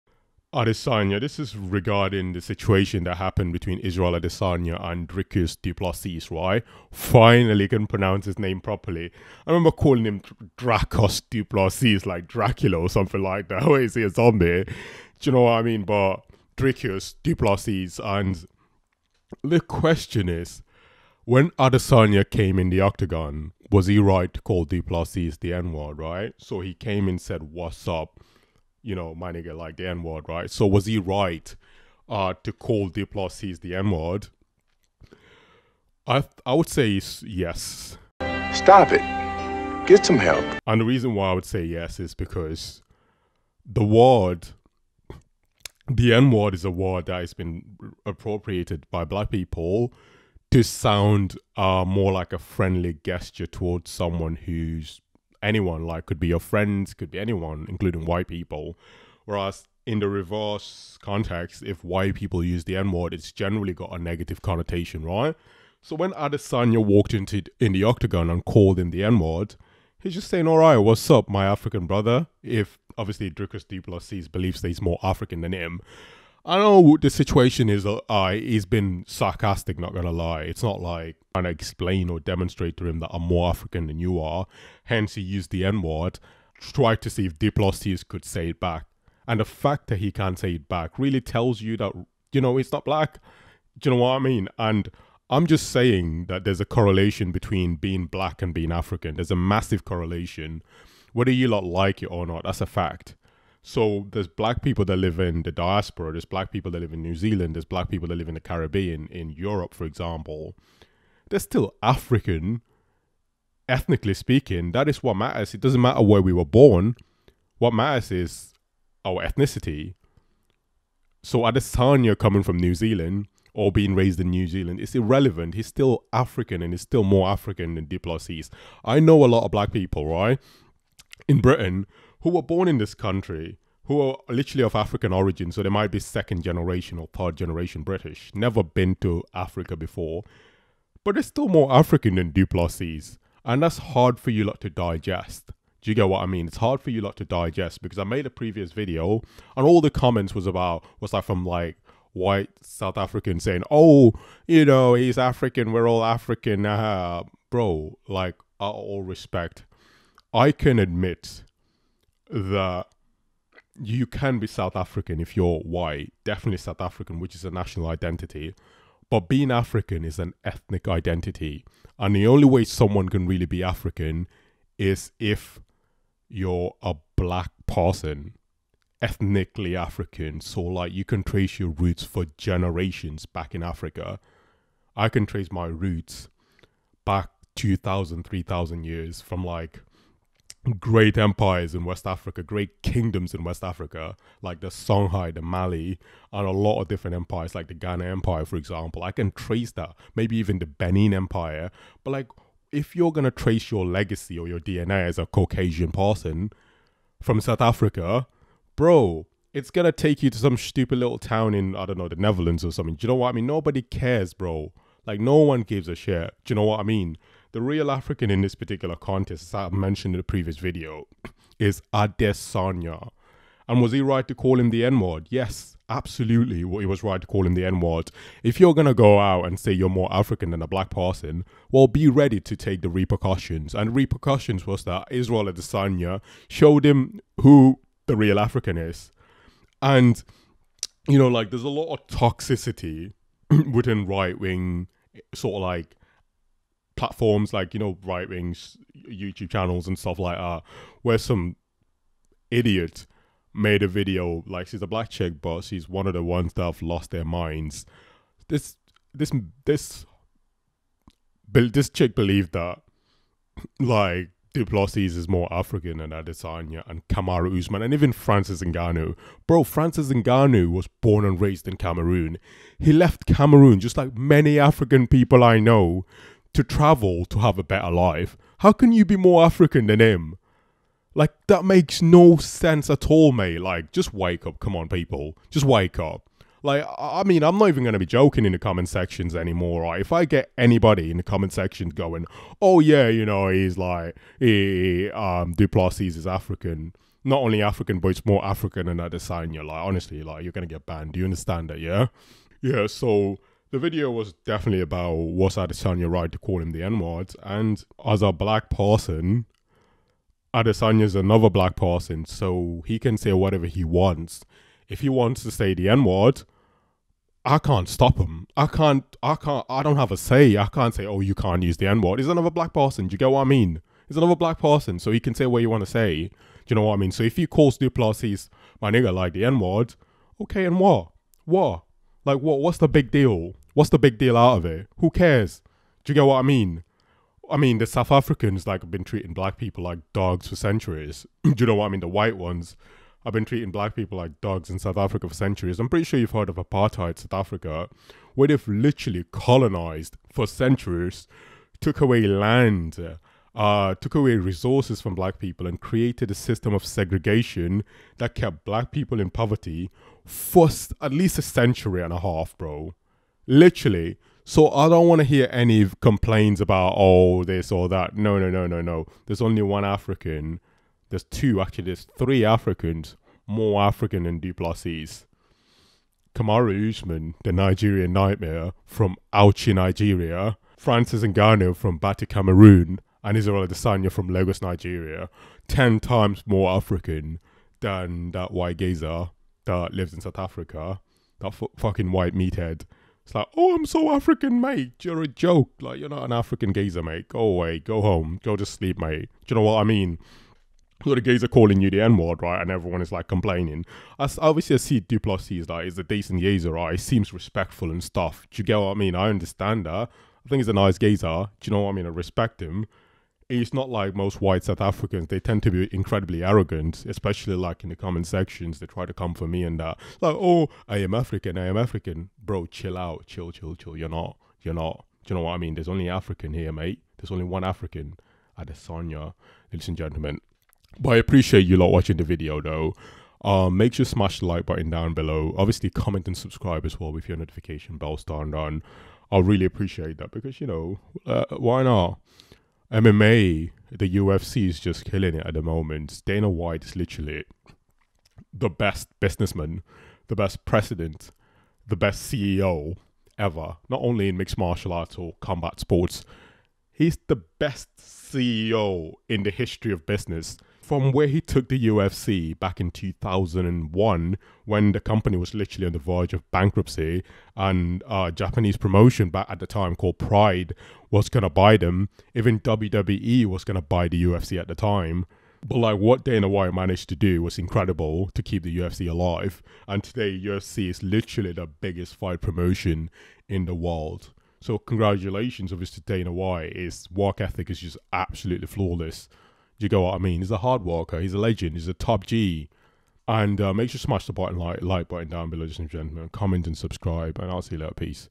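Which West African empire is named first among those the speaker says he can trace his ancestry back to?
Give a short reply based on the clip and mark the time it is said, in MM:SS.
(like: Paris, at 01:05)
Songhai, at 03:14.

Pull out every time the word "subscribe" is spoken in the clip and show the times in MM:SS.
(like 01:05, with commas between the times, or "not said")
07:16, 08:16.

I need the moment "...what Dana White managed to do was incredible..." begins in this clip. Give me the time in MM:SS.
07:55.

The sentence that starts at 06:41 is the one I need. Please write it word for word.
So the geezer calling you the N word, right?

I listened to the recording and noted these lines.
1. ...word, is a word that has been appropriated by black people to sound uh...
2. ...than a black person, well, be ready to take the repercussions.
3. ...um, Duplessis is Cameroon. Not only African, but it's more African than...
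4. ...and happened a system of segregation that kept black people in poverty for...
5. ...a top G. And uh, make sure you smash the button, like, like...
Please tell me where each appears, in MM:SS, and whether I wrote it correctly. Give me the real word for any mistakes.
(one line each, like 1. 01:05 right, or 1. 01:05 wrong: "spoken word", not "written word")
1. 00:46 right
2. 03:50 right
3. 04:55 wrong: "African", not "Cameroon"
4. 05:55 wrong: "created", not "happened"
5. 08:11 right.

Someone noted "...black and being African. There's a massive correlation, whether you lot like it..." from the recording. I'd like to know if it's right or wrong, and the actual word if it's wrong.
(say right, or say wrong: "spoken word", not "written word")
right.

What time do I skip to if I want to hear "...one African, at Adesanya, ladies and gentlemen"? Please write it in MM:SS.
07:07.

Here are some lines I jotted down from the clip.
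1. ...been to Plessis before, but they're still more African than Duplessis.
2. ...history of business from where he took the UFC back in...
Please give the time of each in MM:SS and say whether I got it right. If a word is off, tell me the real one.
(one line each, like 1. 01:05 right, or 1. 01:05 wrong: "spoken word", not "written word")
1. 02:18 wrong: "Africa", not "Plessis"
2. 07:39 right.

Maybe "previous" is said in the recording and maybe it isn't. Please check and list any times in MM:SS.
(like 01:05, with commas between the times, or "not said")
02:28, 03:40.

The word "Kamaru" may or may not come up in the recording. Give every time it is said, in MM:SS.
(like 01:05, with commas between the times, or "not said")
04:27, 06:16.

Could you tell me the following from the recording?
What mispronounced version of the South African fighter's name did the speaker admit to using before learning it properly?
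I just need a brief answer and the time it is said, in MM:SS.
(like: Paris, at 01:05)
Dracos Duplassis, at 00:10.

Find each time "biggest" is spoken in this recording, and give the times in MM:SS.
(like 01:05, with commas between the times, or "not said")
08:01.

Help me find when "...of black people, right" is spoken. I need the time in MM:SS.
02:09.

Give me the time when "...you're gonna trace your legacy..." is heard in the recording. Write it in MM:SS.
03:22.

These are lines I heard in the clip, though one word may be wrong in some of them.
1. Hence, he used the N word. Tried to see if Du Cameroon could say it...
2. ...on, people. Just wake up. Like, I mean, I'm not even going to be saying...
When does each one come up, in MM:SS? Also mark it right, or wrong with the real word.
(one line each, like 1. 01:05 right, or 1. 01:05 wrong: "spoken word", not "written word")
1. 01:24 wrong: "Plessis", not "Cameroon"
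2. 04:44 wrong: "joking", not "saying".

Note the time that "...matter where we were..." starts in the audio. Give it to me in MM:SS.
01:55.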